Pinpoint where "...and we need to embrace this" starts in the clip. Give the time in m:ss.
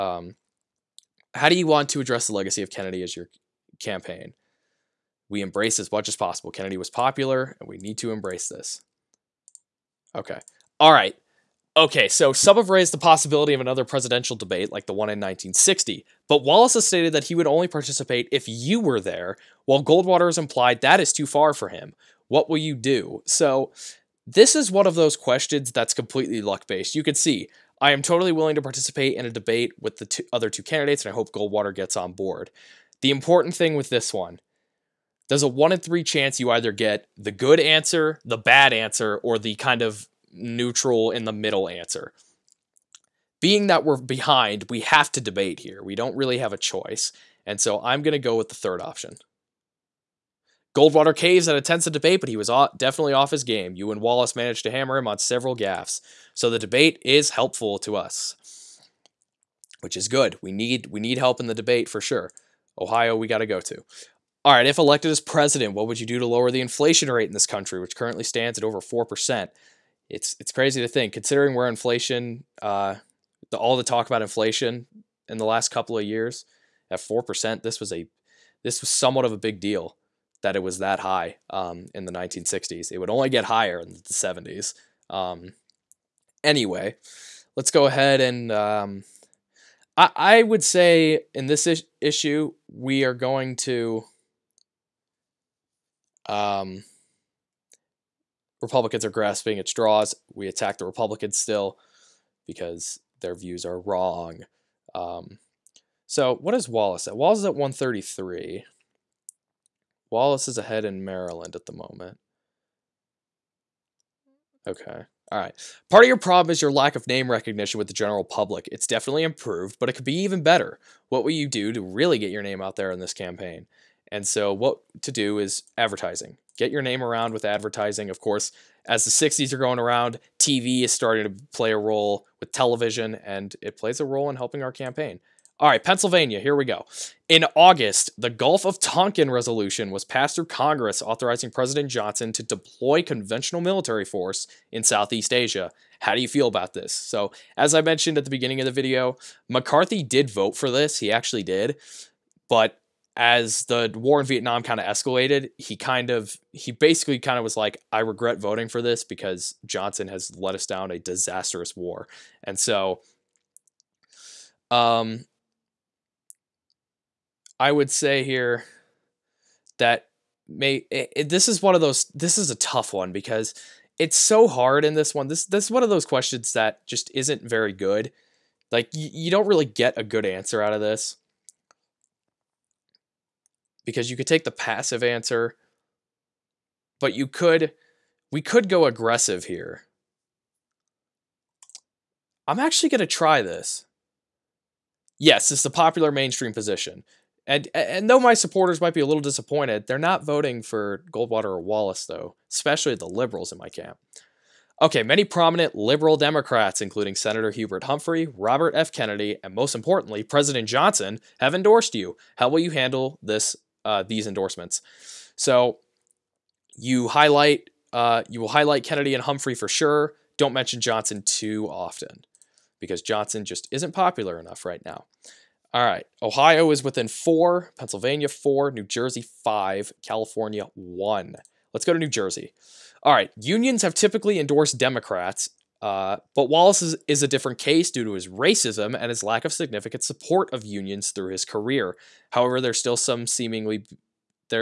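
0:07.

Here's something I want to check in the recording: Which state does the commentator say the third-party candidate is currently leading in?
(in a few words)
Maryland.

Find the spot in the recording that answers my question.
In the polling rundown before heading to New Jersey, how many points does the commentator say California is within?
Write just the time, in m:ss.
3:50.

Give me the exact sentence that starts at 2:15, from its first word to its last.
All right, Pennsylvania, here we go.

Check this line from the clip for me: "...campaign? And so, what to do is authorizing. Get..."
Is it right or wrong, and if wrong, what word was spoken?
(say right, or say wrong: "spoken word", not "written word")
wrong: "advertising", not "authorizing".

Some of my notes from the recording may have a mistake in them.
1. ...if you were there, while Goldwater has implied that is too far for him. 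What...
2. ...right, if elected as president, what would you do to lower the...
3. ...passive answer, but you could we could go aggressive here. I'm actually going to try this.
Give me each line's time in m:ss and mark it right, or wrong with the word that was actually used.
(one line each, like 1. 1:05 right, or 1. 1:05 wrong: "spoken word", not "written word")
1. 0:18 right
2. 1:04 right
3. 3:04 right.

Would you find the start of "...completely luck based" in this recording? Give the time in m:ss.
0:25.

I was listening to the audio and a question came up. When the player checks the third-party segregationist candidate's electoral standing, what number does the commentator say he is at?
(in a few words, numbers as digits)
133.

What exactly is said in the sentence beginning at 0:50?
Goldwater caves at a tense debate, but he was definitely off his game.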